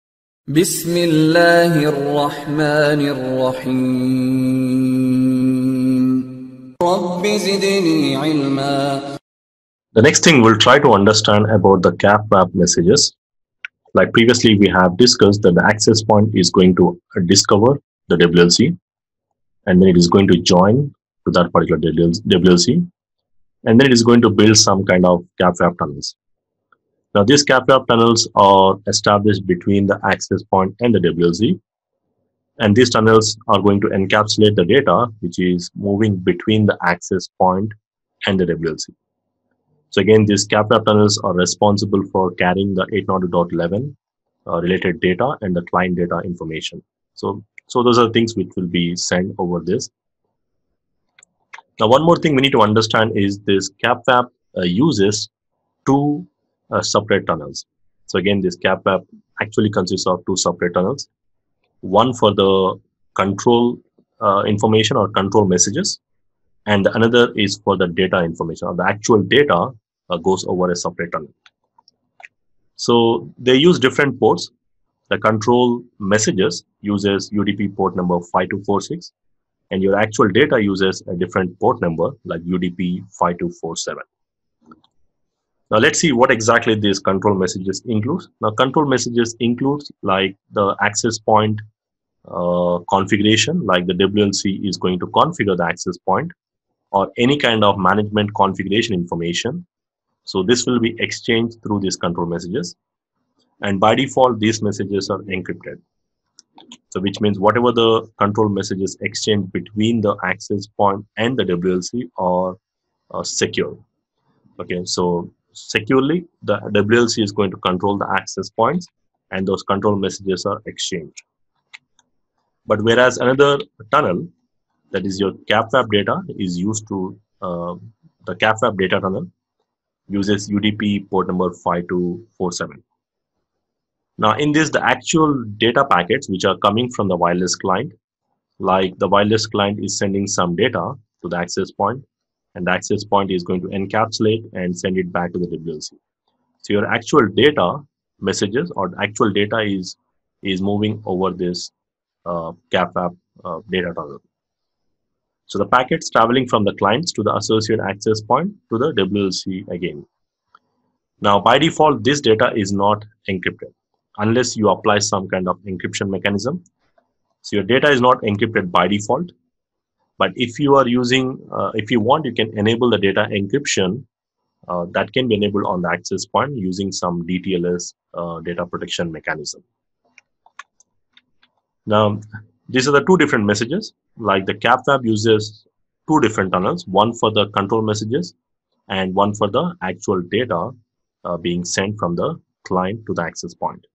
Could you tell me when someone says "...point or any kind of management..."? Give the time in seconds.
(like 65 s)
95 s.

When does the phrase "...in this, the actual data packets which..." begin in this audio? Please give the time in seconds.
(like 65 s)
134 s.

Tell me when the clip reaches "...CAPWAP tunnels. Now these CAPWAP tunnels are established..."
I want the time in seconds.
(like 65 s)
25 s.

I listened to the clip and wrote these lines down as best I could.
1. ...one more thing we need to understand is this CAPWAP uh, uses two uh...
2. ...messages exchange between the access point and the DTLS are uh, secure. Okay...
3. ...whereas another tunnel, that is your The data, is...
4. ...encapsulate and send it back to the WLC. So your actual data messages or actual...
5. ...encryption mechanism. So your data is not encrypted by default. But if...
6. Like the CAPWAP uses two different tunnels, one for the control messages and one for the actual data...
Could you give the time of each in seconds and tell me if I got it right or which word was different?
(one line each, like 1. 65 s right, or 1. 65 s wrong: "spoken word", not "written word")
1. 51 s right
2. 108 s wrong: "WLC", not "DTLS"
3. 122 s wrong: "CAPWAP", not "The"
4. 143 s right
5. 165 s right
6. 184 s right.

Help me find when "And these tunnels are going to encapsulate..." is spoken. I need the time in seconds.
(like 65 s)
32 s.